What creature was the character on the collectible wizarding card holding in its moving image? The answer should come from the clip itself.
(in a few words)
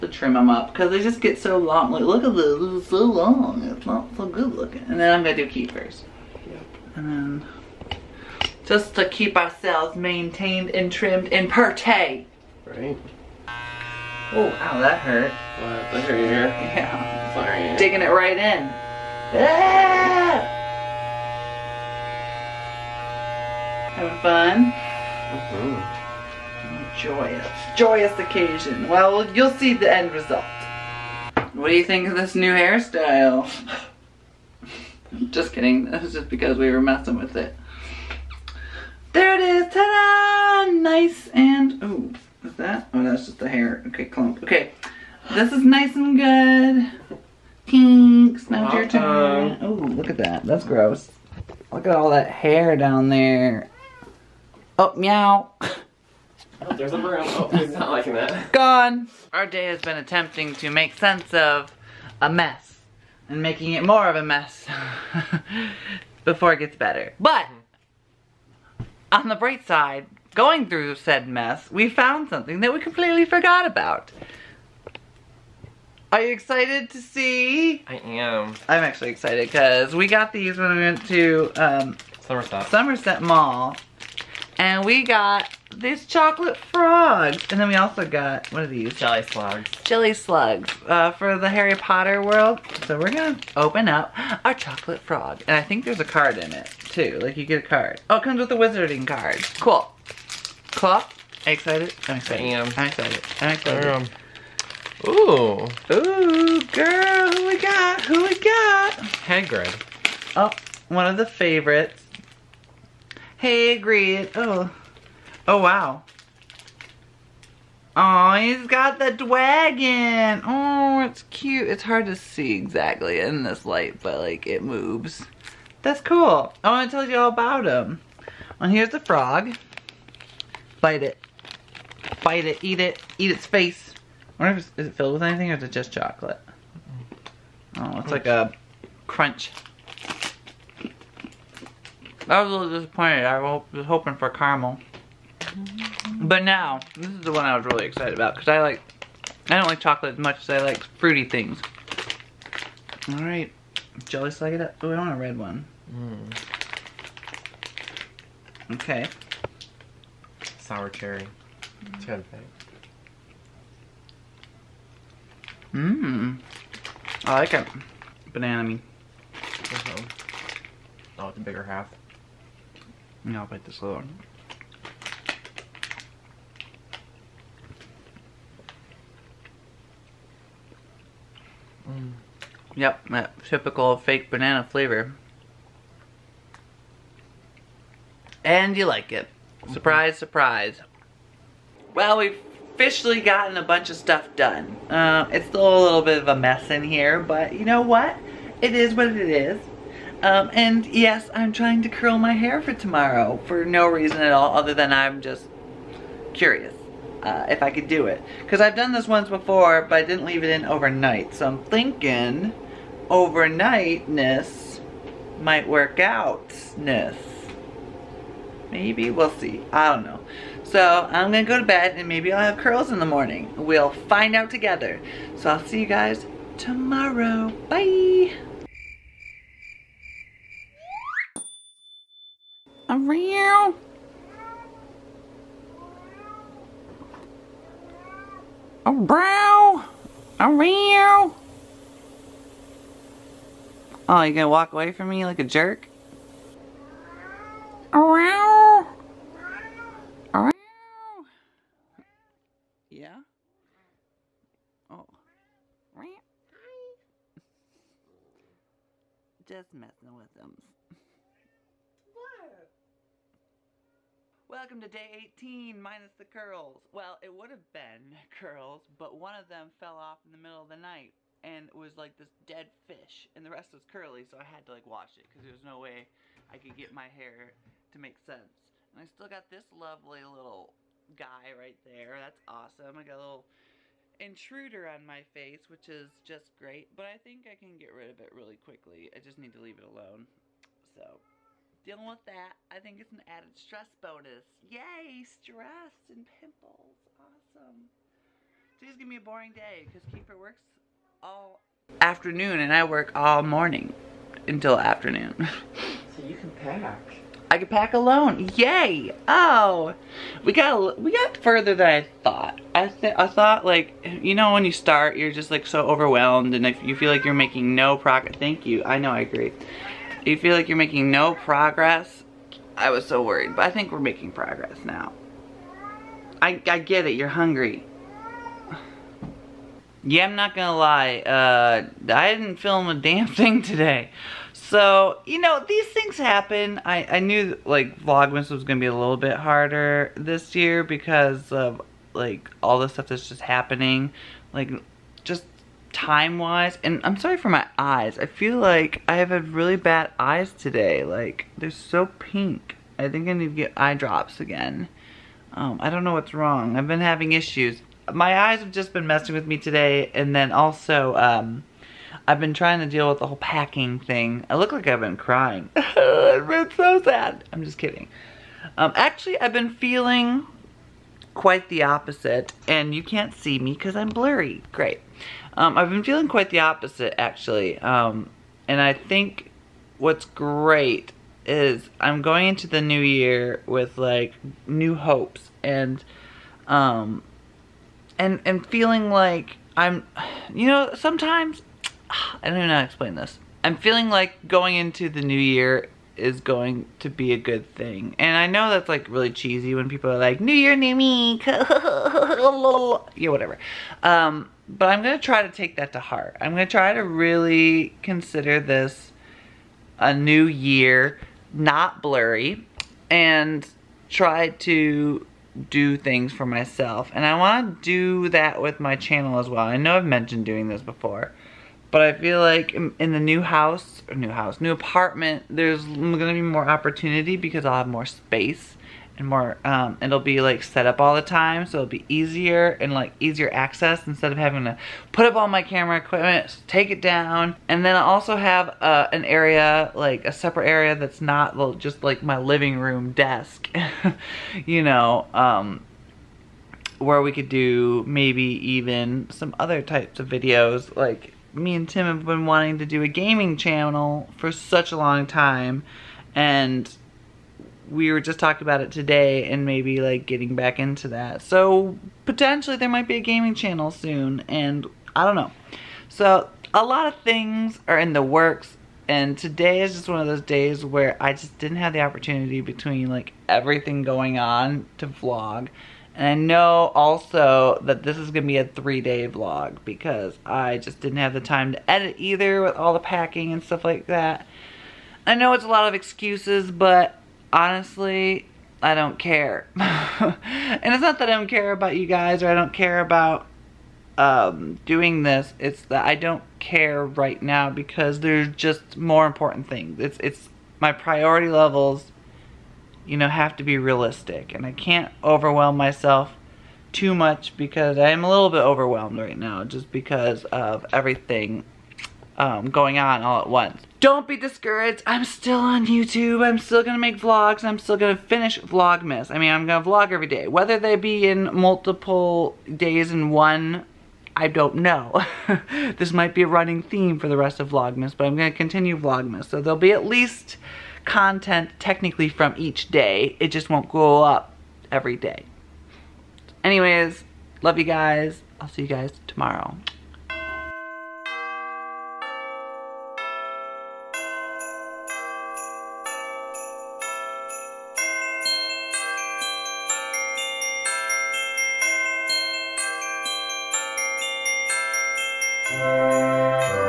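Dragon.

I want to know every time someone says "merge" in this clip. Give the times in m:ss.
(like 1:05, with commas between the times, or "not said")
not said.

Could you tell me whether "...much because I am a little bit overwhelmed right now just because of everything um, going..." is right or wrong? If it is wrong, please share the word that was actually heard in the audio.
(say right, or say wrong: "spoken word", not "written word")
right.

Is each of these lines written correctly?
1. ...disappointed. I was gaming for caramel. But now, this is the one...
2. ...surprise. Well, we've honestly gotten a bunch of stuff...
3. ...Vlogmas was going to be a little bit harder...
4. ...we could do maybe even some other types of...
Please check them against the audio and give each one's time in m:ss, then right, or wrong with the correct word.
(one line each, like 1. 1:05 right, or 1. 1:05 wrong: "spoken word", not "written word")
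1. 2:22 wrong: "hoping", not "gaming"
2. 3:10 wrong: "officially", not "honestly"
3. 5:38 right
4. 7:27 right.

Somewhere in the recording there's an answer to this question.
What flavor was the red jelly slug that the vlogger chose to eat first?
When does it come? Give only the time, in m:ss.
2:40.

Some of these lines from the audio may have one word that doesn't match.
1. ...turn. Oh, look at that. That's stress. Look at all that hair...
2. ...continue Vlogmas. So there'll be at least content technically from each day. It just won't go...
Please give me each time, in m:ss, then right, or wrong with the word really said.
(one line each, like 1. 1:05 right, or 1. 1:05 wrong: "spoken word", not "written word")
1. 0:49 wrong: "gross", not "stress"
2. 8:48 right.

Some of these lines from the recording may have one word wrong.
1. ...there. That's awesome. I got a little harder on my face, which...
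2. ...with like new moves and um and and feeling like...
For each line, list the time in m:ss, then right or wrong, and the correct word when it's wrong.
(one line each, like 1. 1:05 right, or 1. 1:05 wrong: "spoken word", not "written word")
1. 4:41 wrong: "intruder", not "harder"
2. 6:23 wrong: "hopes", not "moves".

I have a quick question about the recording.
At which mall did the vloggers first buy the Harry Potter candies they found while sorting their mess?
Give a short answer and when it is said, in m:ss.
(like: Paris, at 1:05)
Somerset Mall, at 1:22.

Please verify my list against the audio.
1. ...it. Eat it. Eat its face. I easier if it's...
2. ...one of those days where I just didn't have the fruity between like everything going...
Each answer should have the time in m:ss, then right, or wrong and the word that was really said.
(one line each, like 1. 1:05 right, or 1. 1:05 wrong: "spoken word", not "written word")
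1. 2:12 wrong: "wonder", not "easier"
2. 7:50 wrong: "opportunity", not "fruity".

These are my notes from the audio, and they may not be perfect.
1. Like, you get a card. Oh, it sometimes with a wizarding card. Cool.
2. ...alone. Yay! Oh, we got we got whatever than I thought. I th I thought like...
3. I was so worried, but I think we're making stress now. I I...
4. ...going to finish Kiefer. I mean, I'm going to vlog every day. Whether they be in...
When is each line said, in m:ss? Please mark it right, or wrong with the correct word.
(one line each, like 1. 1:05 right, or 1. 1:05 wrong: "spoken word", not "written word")
1. 1:37 wrong: "comes", not "sometimes"
2. 5:07 wrong: "further", not "whatever"
3. 5:22 wrong: "progress", not "stress"
4. 8:37 wrong: "Vlogmas", not "Kiefer".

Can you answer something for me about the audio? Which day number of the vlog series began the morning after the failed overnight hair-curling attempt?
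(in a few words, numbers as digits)
Day 18.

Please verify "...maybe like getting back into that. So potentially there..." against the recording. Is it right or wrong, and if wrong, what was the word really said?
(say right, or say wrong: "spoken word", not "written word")
right.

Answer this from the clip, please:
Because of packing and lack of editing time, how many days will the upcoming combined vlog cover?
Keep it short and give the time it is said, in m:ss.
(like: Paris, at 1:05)
3, at 7:58.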